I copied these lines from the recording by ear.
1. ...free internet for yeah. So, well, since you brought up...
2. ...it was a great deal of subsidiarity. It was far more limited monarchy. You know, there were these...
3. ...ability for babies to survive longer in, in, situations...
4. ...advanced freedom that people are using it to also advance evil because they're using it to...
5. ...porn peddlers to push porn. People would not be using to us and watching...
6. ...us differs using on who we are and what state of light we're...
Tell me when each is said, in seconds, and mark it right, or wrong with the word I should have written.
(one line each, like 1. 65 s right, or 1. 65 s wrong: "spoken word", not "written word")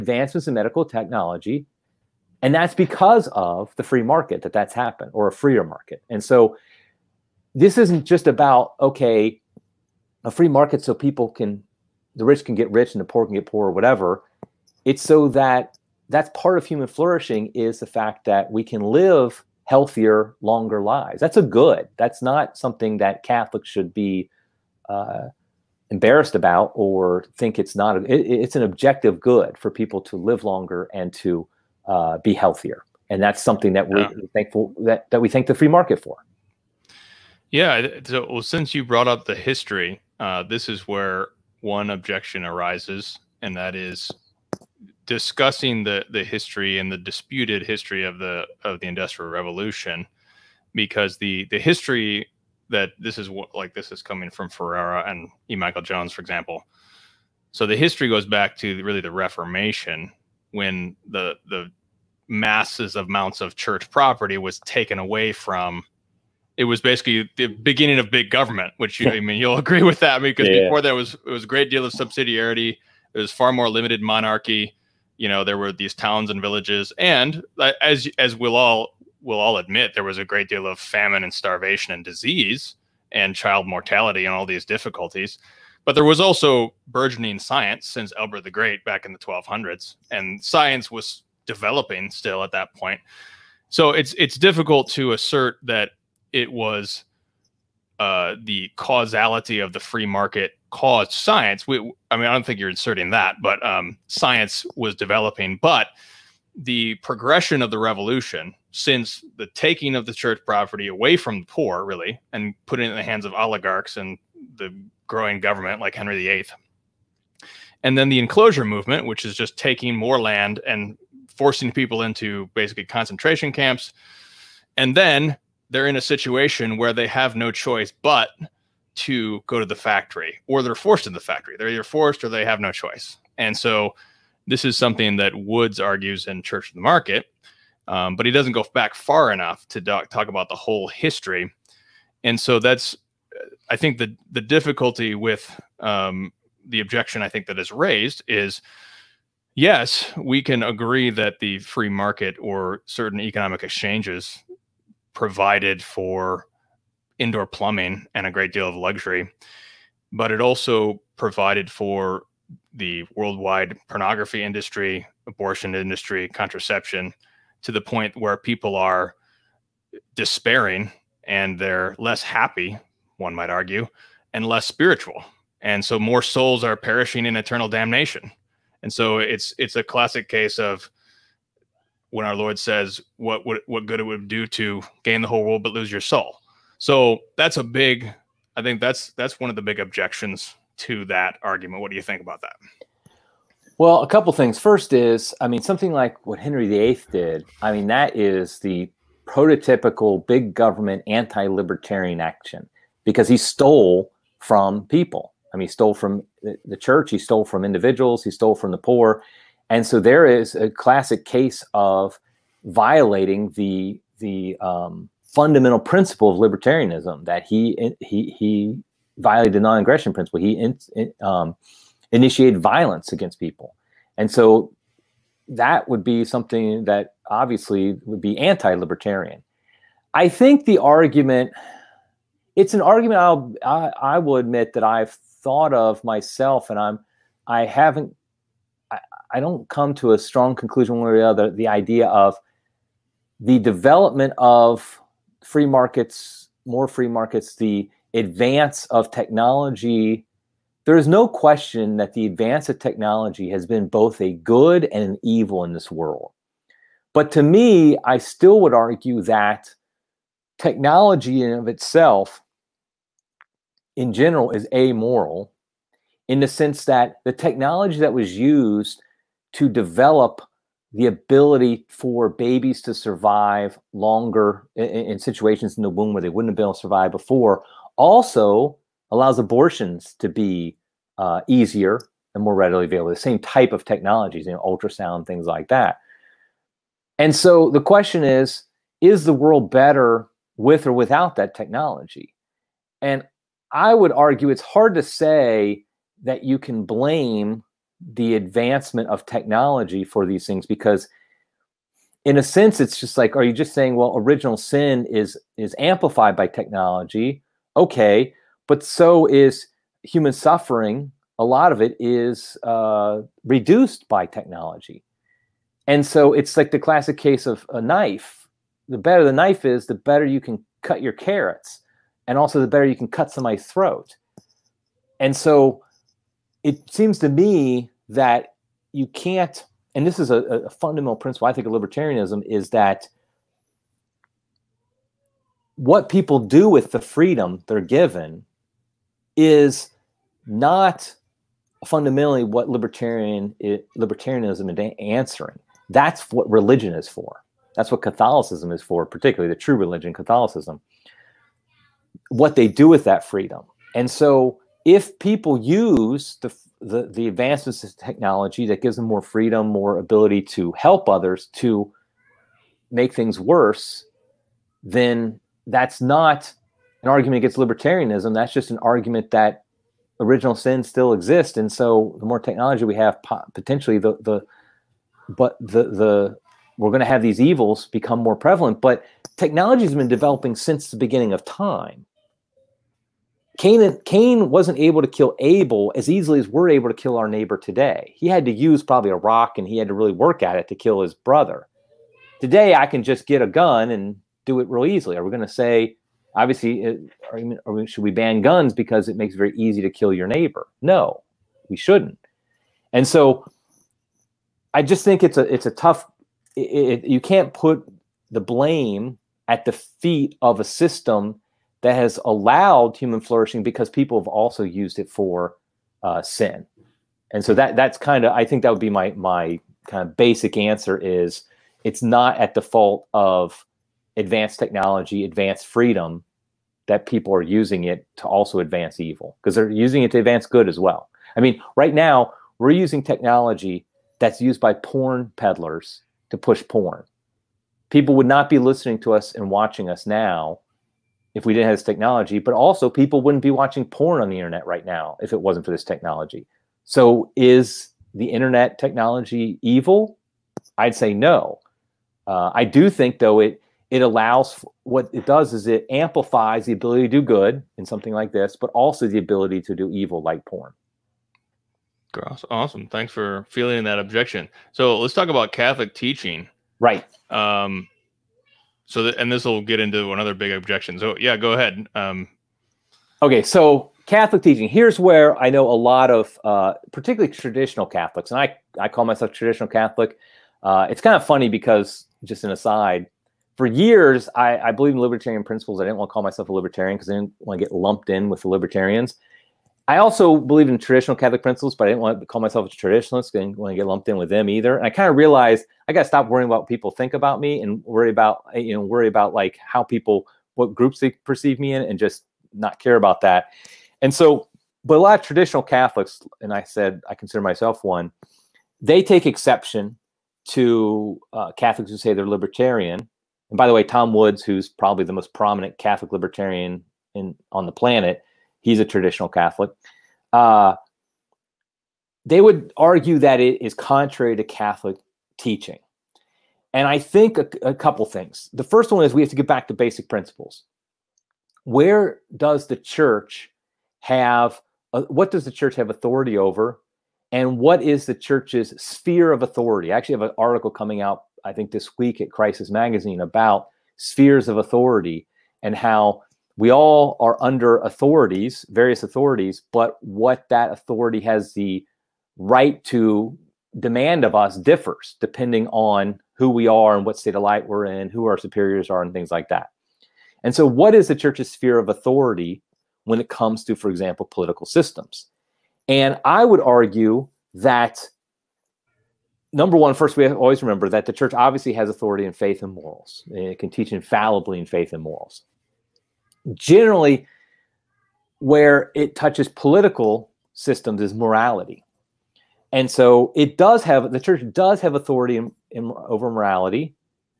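1. 35 s wrong: "market", not "internet"
2. 71 s right
3. 271 s right
4. 425 s right
5. 434 s wrong: "listening", not "using"
6. 554 s wrong: "depending", not "using".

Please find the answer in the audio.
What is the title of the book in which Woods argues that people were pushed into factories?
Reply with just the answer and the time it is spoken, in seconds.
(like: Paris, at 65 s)
Church of the Market, at 136 s.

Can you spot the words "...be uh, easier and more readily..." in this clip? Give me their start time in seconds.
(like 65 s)
280 s.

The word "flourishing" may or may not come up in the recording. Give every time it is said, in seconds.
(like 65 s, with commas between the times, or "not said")
16 s, 413 s.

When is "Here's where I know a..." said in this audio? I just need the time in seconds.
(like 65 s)
474 s.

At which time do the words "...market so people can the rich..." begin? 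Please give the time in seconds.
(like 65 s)
10 s.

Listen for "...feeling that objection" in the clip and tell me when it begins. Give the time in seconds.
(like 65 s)
463 s.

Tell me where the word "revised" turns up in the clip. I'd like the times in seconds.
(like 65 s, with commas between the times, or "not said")
not said.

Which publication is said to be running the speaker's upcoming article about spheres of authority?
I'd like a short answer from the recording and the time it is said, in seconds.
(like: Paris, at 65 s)
Crisis Magazine, at 542 s.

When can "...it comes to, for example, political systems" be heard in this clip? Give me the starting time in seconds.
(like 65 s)
563 s.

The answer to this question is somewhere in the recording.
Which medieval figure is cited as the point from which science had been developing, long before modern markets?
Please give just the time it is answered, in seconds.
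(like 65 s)
88 s.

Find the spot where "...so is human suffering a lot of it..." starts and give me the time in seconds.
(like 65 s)
308 s.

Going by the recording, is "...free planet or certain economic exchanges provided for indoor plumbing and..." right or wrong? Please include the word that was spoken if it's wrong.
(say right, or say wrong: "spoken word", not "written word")
wrong: "market", not "planet".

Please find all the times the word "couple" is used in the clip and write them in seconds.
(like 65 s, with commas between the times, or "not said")
194 s, 527 s.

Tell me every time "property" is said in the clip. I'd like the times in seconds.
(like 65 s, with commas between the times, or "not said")
63 s, 110 s.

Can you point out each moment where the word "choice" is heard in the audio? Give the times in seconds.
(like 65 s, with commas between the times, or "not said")
127 s, 132 s.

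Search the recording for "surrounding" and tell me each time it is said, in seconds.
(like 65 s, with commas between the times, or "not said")
not said.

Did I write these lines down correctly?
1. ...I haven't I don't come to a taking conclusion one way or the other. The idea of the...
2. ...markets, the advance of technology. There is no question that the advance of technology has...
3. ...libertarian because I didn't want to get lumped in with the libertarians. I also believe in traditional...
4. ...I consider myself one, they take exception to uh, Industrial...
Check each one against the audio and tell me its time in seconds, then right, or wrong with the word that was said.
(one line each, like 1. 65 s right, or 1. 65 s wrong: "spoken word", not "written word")
1. 237 s wrong: "strong", not "taking"
2. 247 s right
3. 486 s right
4. 507 s wrong: "Catholics", not "Industrial".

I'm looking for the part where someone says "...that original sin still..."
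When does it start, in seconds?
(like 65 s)
369 s.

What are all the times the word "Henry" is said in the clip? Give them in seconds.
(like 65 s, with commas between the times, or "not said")
115 s, 196 s.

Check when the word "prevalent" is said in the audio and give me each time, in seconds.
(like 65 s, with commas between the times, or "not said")
378 s.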